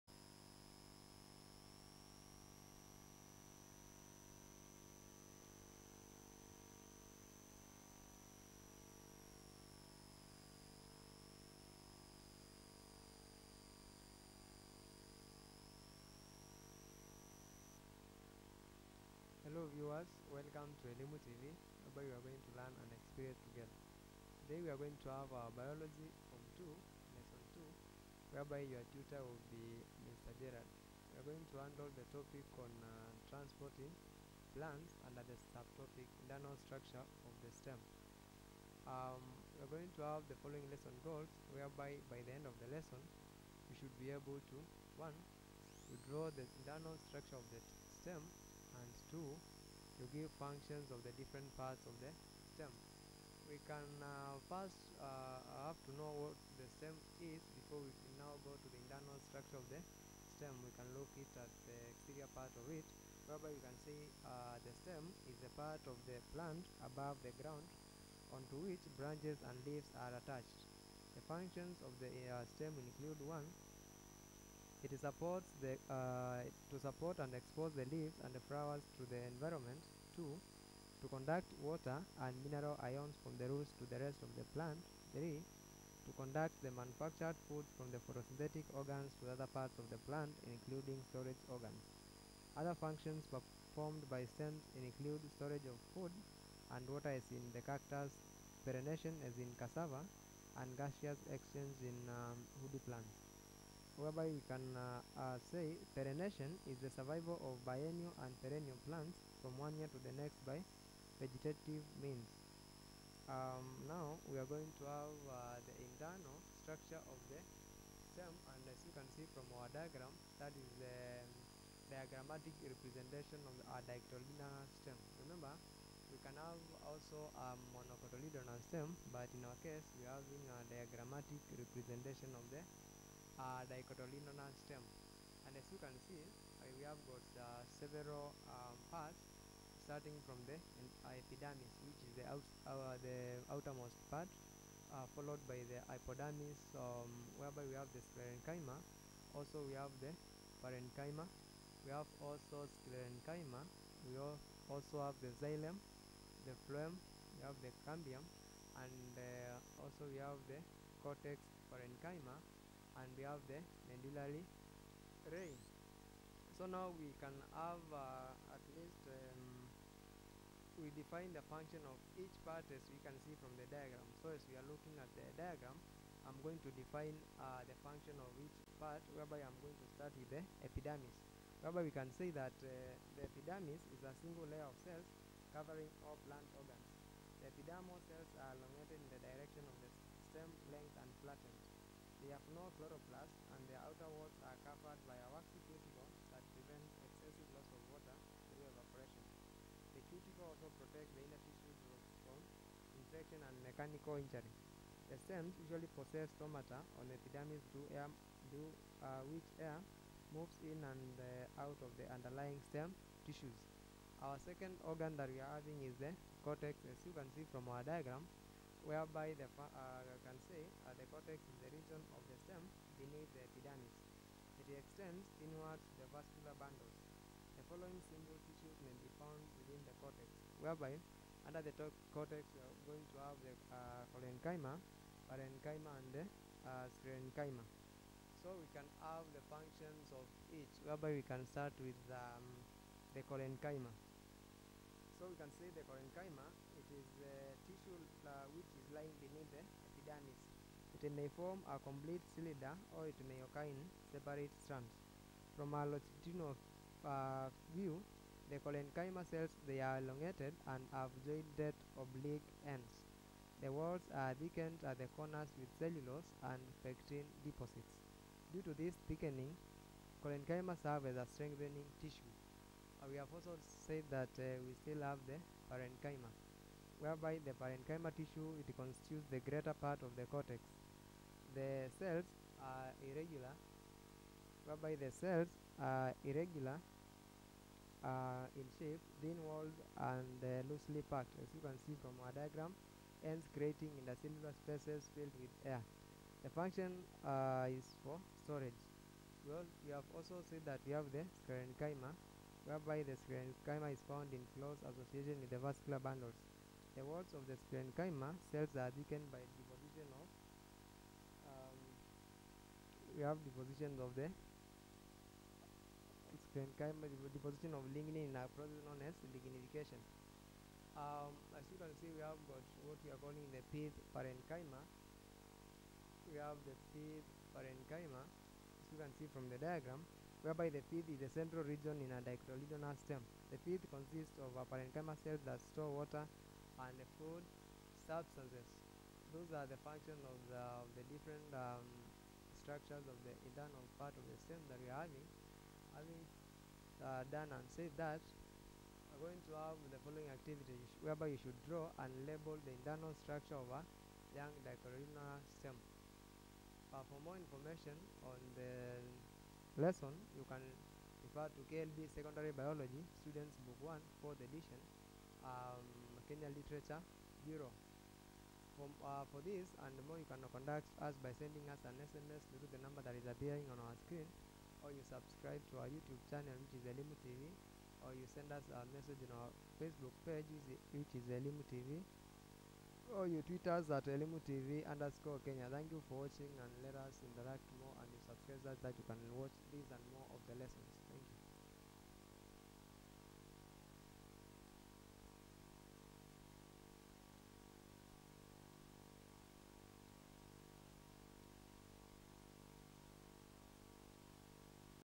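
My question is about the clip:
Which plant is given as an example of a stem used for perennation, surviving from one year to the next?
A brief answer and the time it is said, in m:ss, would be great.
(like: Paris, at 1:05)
cassava, at 1:39.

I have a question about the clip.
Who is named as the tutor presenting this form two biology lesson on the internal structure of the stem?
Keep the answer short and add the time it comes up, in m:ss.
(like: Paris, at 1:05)
Mr. Gerard, at 0:30.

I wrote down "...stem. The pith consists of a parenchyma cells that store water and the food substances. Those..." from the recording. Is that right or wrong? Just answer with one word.
right.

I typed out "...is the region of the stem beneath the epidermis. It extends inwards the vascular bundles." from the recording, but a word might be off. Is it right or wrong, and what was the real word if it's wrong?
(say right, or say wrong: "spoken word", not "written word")
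right.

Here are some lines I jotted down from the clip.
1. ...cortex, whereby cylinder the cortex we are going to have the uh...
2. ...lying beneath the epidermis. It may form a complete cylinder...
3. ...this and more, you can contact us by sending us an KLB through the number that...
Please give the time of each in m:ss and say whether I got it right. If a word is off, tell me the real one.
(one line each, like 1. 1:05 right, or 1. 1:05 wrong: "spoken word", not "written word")
1. 3:50 wrong: "under", not "cylinder"
2. 4:08 right
3. 6:09 wrong: "SMS", not "KLB".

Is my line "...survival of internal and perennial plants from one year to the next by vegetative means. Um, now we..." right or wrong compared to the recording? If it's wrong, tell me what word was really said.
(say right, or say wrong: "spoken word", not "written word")
wrong: "biennial", not "internal".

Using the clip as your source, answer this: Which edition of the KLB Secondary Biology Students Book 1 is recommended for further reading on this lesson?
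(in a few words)
4th edition.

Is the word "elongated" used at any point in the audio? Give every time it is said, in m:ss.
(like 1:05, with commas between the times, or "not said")
3:08, 4:20.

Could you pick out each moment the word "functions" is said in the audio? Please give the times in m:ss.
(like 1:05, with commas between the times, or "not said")
0:50, 1:11, 1:32, 2:51, 2:57, 3:59, 4:56, 5:39.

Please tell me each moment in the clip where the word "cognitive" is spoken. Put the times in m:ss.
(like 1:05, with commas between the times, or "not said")
not said.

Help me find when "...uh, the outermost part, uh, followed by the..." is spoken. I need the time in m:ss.
2:22.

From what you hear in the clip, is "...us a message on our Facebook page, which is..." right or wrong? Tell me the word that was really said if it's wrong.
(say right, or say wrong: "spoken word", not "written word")
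right.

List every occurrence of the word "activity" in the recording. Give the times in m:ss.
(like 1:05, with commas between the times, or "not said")
5:50.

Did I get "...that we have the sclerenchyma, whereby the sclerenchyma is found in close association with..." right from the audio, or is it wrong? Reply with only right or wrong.
right.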